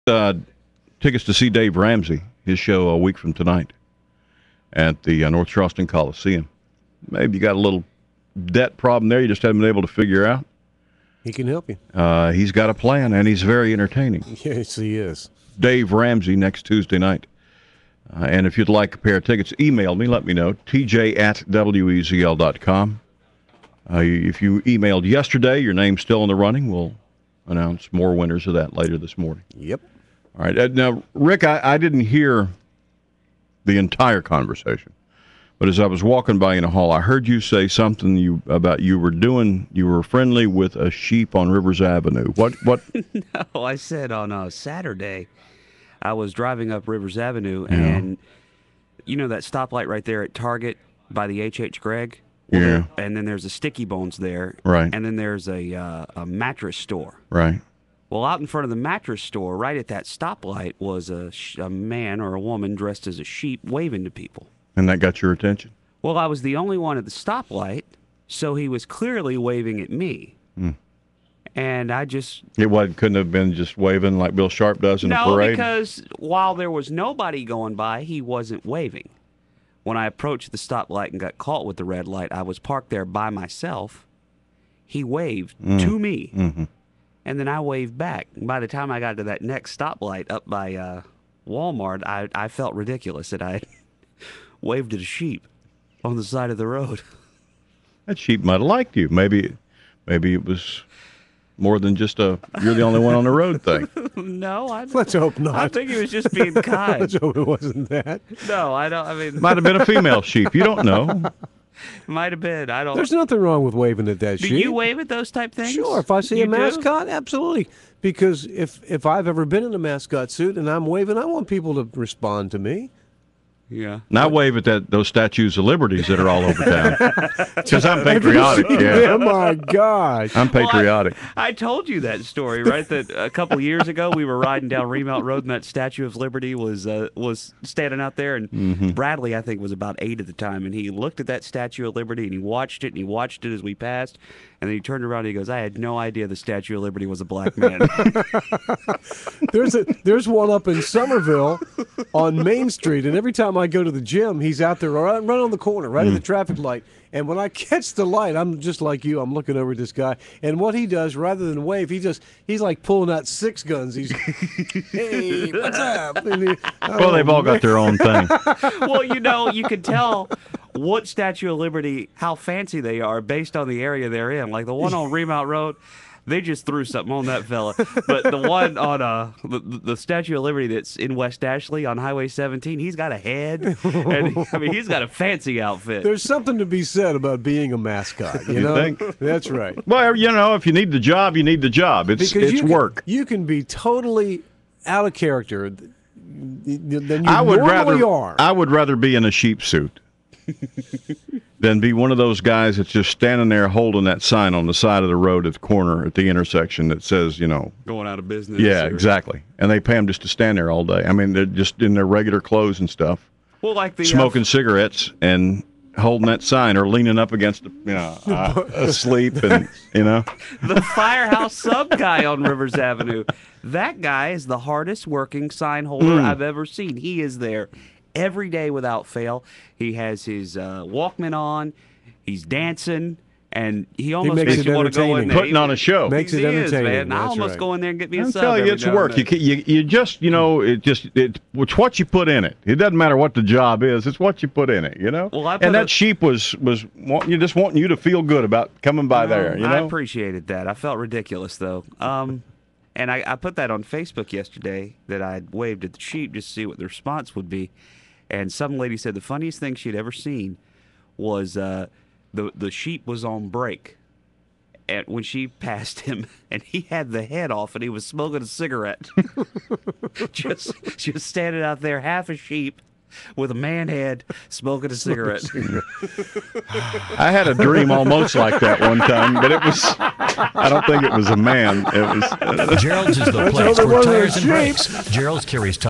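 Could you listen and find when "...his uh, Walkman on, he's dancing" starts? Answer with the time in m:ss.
3:50.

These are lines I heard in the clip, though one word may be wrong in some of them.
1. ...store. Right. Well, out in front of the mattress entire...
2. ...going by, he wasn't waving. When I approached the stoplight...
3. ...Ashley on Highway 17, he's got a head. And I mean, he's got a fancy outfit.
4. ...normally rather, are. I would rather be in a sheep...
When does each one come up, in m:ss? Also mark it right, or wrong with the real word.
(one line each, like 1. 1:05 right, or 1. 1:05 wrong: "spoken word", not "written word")
1. 0:56 wrong: "store", not "entire"
2. 1:17 right
3. 3:01 right
4. 3:17 right.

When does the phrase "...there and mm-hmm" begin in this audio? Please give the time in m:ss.
2:18.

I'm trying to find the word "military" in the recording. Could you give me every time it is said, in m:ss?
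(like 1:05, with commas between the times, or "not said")
not said.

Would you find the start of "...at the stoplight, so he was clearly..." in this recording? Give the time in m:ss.
1:06.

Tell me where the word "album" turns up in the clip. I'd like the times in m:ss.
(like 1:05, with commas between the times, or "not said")
not said.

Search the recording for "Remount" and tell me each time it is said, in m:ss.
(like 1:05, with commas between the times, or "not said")
2:14, 2:55.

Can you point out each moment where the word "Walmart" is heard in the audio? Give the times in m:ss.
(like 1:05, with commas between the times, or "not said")
1:31.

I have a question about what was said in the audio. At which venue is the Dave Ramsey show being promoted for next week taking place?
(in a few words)
North Charleston Coliseum.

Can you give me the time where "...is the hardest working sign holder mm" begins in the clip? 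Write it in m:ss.
3:44.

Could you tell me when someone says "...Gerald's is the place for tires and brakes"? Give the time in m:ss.
4:42.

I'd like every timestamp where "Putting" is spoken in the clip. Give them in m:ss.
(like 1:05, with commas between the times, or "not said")
3:55.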